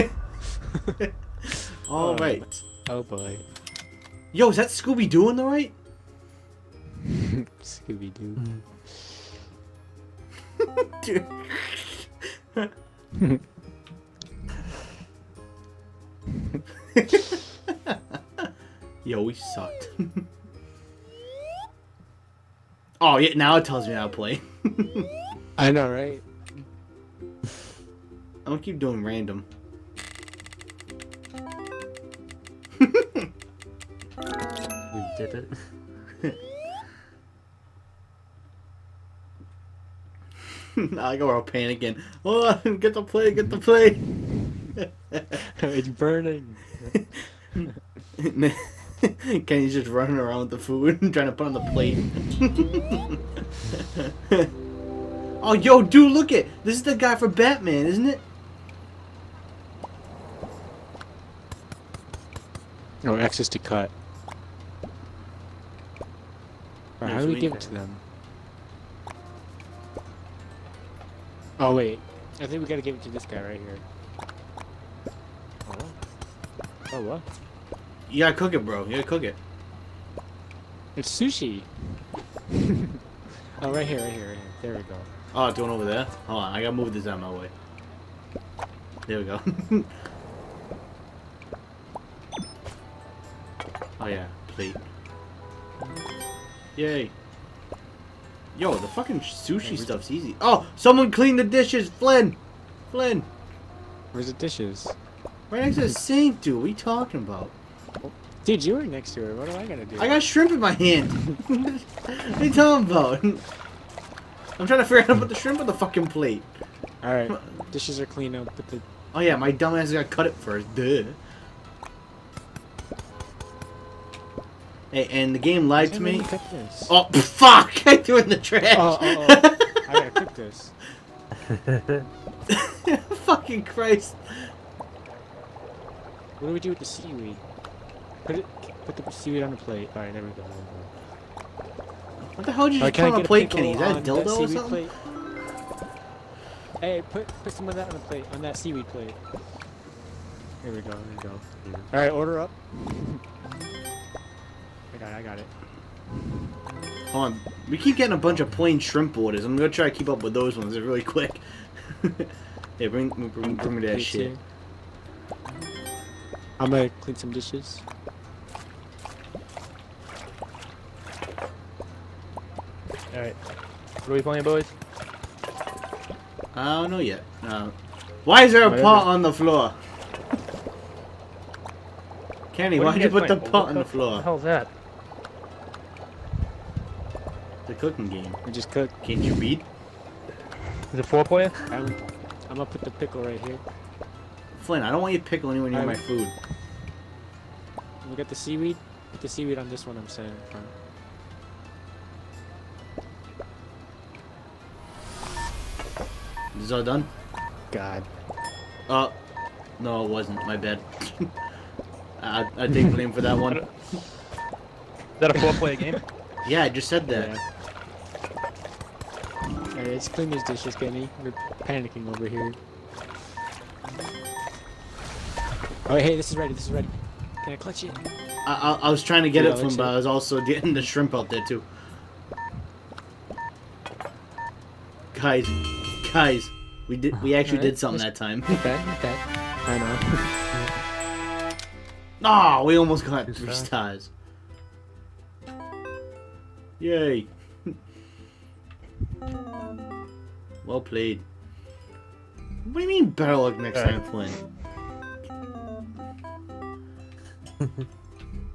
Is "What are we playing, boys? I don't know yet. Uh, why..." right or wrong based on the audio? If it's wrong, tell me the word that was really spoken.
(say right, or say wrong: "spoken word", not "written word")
right.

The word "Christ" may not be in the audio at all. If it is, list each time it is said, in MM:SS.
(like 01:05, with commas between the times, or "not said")
02:13.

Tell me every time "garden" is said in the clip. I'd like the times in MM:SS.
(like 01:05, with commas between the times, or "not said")
not said.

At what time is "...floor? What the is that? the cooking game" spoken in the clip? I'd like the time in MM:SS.
03:03.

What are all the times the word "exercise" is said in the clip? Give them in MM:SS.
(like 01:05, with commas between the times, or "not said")
not said.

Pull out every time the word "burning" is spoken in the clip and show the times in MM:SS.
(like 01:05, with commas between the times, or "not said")
00:45.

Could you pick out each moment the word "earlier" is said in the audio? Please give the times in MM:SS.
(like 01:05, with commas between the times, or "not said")
not said.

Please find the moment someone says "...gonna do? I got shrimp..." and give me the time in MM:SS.
01:49.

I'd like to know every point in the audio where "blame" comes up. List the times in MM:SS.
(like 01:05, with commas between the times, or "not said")
03:32.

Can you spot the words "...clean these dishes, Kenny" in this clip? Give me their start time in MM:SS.
03:40.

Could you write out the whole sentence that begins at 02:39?
I'm gonna try to keep up with those ones.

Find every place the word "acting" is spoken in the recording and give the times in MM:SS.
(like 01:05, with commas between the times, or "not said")
not said.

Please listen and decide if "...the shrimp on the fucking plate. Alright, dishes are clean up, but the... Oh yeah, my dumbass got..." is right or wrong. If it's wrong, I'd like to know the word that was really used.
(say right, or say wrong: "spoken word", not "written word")
right.